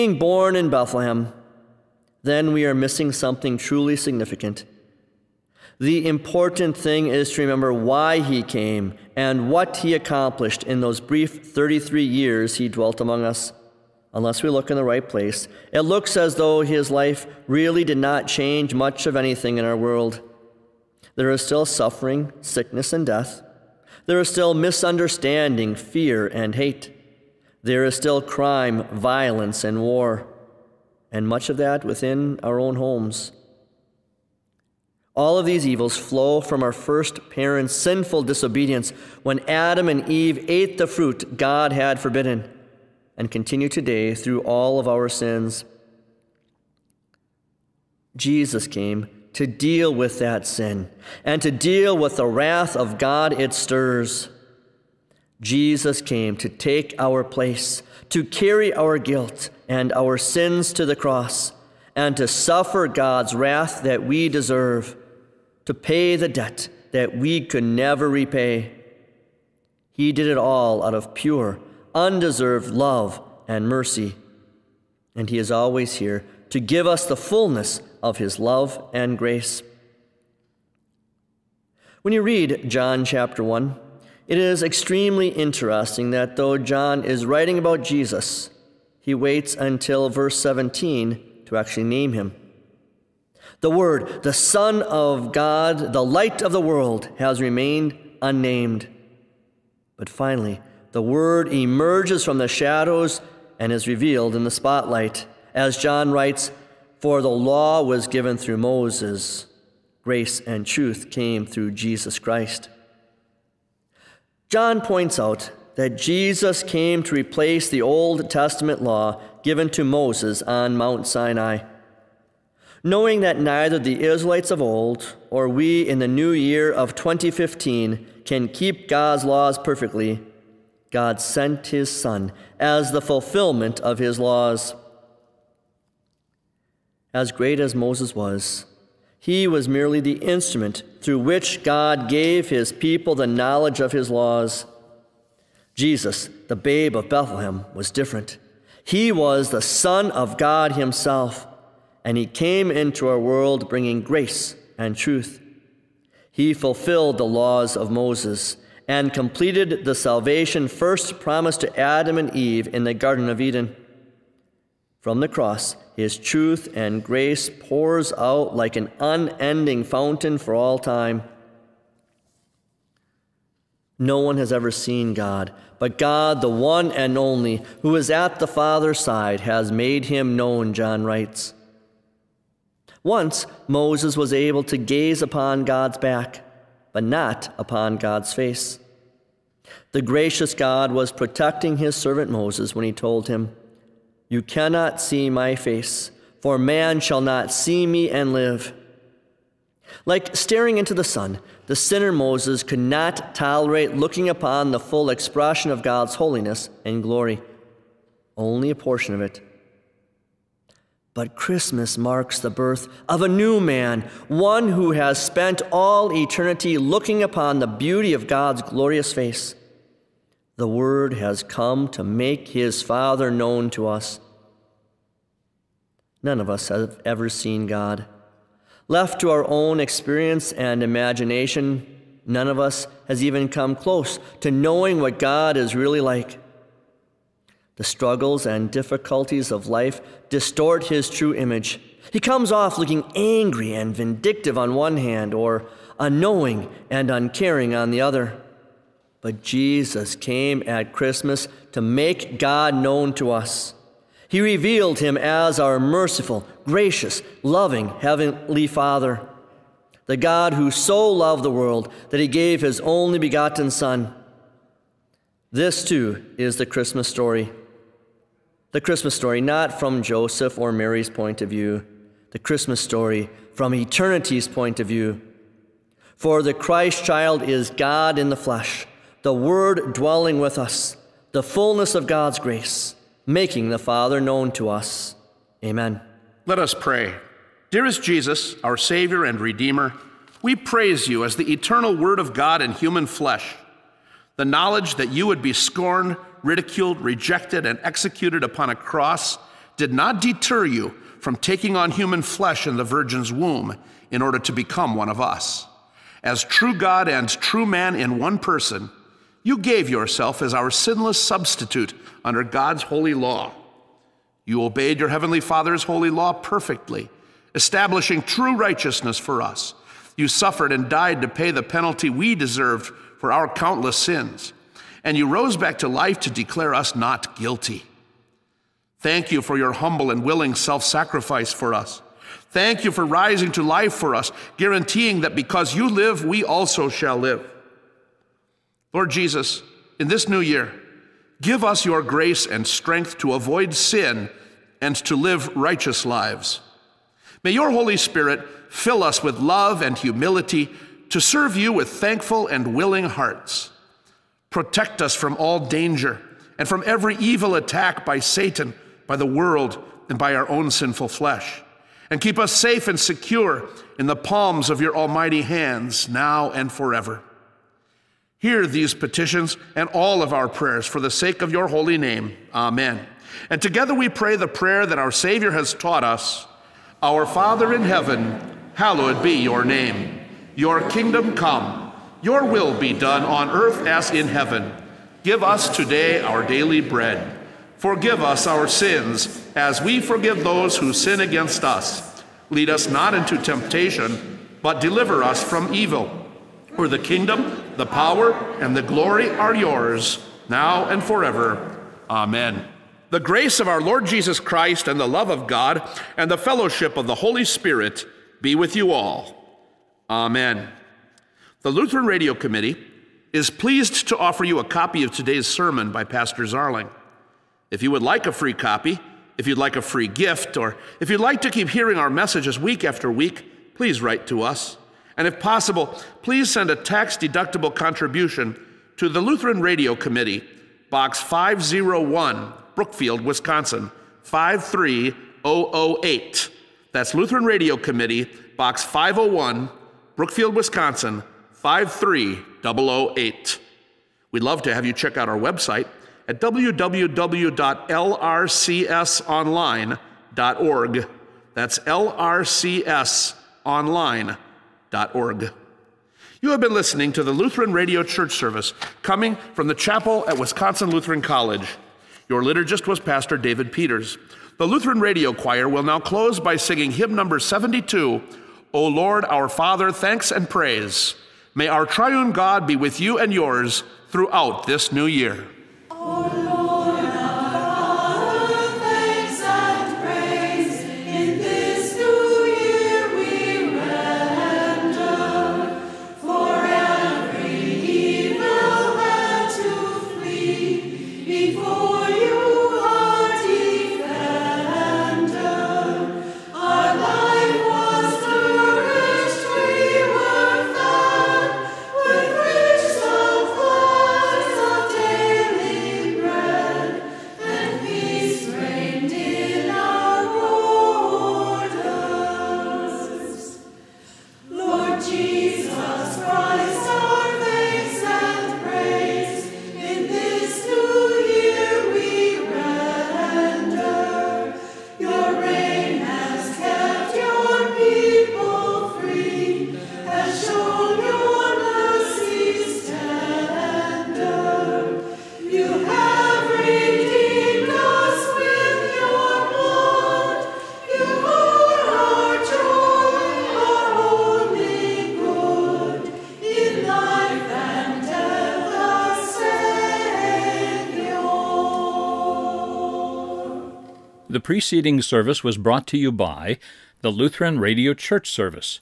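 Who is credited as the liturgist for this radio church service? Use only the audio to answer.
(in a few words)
Pastor David Peters.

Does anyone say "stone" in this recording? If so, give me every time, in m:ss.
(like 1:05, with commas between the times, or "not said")
not said.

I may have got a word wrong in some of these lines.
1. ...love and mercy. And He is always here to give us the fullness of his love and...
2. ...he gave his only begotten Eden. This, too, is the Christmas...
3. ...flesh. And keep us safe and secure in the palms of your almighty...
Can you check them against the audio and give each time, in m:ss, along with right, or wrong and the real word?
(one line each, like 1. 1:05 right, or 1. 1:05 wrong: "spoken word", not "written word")
1. 1:12 right
2. 4:22 wrong: "Son", not "Eden"
3. 6:01 right.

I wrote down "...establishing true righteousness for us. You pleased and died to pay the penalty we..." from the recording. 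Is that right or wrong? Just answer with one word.
wrong.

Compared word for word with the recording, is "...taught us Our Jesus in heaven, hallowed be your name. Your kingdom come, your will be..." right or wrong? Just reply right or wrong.
wrong.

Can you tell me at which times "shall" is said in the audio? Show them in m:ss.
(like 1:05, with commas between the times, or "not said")
3:16, 5:36.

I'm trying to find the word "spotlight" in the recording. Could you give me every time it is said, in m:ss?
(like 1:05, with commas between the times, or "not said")
1:44.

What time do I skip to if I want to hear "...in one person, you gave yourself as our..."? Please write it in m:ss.
5:07.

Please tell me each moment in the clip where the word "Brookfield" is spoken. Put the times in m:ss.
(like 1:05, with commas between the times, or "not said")
7:12, 7:20.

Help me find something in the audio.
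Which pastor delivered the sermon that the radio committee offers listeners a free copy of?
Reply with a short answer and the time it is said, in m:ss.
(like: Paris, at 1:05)
Pastor Zarling, at 6:56.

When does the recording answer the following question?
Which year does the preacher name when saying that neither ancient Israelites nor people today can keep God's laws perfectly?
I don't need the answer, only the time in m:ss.
2:06.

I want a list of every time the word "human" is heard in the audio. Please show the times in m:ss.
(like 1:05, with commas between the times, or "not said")
4:52, 5:01.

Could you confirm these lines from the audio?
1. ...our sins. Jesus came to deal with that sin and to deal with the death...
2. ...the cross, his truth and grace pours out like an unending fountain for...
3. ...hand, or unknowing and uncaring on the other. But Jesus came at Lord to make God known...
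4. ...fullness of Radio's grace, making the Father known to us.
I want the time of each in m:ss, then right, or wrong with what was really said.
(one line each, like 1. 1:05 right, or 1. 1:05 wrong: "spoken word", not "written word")
1. 0:44 wrong: "wrath", not "death"
2. 2:45 right
3. 4:04 wrong: "Christmas", not "Lord"
4. 4:41 wrong: "God", not "Radio".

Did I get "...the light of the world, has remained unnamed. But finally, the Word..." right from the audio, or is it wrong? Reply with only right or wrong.
right.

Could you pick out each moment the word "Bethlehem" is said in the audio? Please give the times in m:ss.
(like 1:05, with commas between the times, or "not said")
0:00, 2:27.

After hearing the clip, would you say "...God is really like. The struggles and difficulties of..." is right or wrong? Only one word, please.
right.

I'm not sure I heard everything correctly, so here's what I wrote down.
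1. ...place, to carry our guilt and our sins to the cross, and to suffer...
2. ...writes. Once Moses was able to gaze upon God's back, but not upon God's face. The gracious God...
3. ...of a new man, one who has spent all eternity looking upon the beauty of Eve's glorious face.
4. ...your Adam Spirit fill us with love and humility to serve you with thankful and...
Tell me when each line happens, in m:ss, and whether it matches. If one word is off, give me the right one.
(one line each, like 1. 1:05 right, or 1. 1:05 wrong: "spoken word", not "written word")
1. 0:57 right
2. 3:01 right
3. 3:33 wrong: "God", not "Eve"
4. 5:47 wrong: "Holy", not "Adam".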